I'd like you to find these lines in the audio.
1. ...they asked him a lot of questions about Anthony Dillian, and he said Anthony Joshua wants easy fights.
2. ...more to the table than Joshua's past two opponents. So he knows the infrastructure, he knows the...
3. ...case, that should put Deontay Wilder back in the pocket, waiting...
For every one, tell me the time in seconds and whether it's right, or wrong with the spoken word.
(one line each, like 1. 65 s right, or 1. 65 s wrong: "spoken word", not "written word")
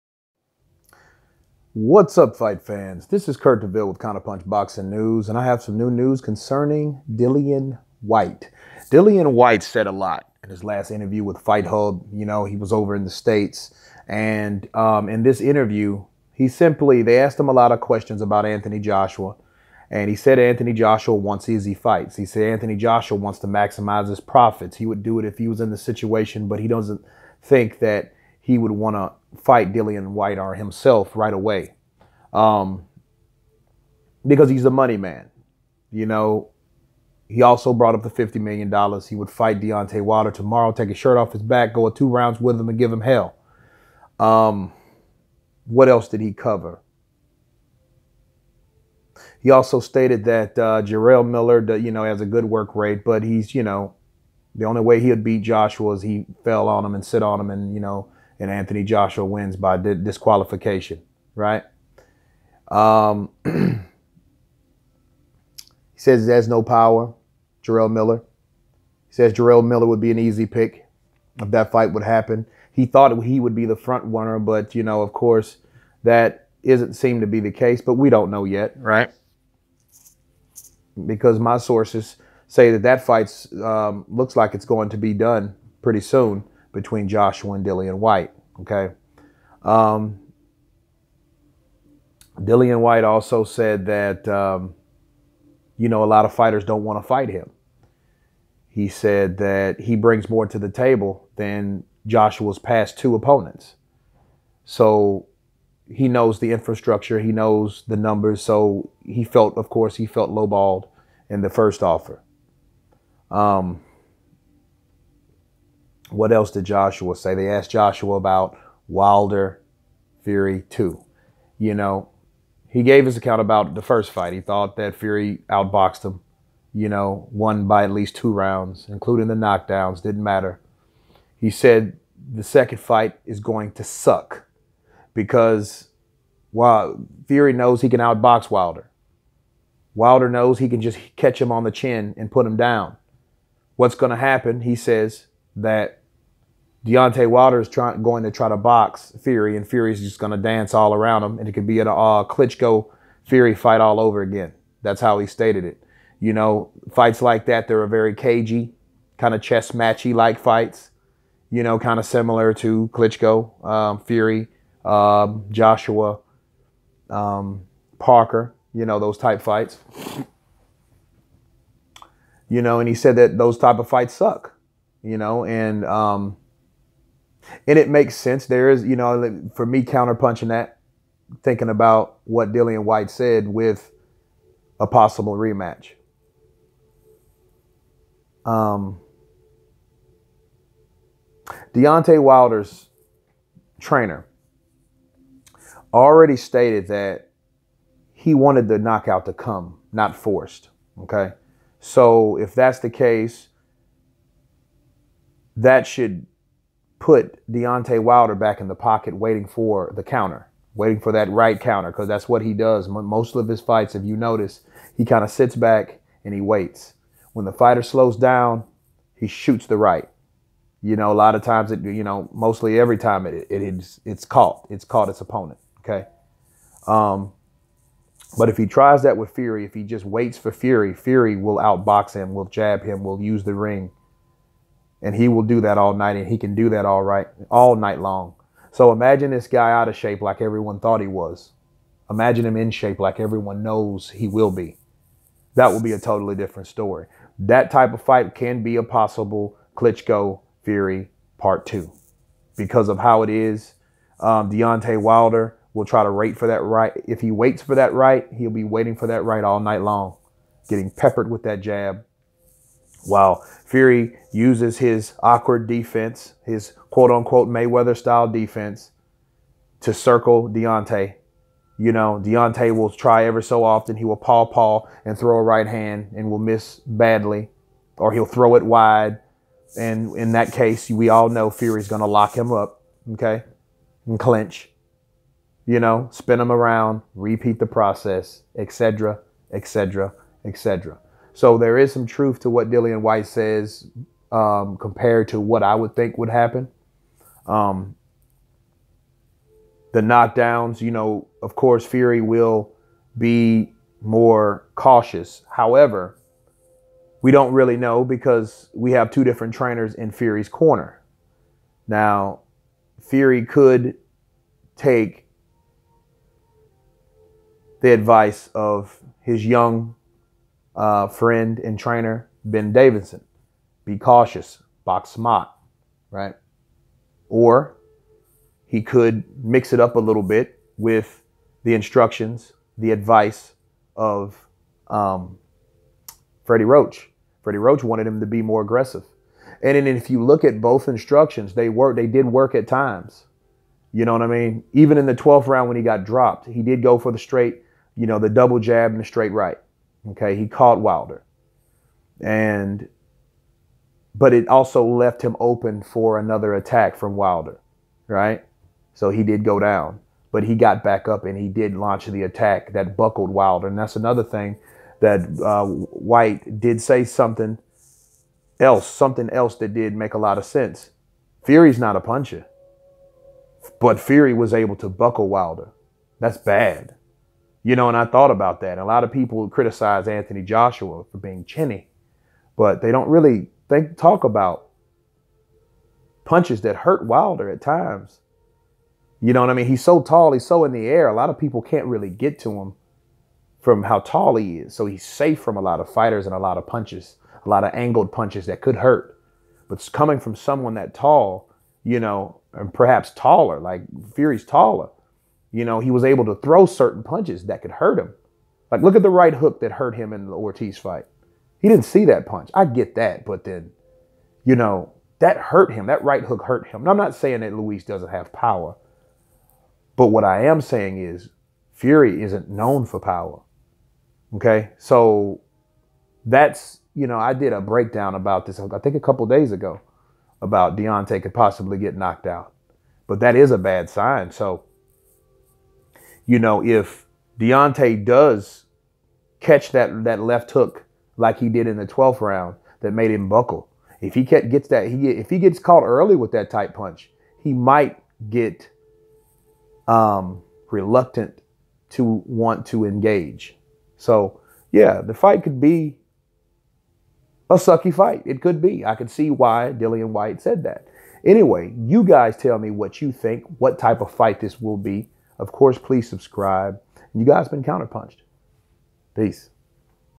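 1. 17 s wrong: "Joshua", not "Dillian"
2. 100 s right
3. 202 s right.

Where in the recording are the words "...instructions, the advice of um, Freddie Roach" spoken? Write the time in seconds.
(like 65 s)
331 s.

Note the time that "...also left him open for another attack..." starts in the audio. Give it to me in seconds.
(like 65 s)
354 s.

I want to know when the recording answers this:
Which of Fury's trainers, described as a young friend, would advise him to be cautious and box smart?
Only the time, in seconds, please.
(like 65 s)
322 s.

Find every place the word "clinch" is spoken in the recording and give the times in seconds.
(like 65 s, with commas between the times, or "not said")
284 s.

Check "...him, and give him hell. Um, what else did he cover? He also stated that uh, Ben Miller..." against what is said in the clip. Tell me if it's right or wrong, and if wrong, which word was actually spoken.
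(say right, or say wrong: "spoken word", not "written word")
wrong: "Jarrell", not "Ben".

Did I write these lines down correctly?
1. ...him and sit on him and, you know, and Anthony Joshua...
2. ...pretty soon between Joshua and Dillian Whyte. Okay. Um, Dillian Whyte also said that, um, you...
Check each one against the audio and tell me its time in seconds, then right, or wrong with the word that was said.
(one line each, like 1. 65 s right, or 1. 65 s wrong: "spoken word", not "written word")
1. 56 s right
2. 85 s right.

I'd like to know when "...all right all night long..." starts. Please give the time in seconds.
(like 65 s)
236 s.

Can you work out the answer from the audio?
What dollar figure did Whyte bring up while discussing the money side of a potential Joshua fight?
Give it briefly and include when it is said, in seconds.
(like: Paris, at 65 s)
$50 million, at 38 s.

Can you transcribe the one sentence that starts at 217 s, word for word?
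When the fighter slows down, he shoots the right.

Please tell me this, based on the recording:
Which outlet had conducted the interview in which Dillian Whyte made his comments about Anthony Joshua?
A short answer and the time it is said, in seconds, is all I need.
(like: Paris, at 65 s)
Fight Hub, at 11 s.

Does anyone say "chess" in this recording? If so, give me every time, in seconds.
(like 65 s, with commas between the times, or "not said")
159 s.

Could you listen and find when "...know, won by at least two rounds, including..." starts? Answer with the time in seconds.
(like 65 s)
126 s.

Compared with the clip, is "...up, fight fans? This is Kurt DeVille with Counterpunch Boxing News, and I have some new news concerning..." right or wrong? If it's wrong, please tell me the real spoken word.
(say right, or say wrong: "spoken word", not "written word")
right.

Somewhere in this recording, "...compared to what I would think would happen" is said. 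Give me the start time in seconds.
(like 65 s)
294 s.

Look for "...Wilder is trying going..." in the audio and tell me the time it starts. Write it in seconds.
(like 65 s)
147 s.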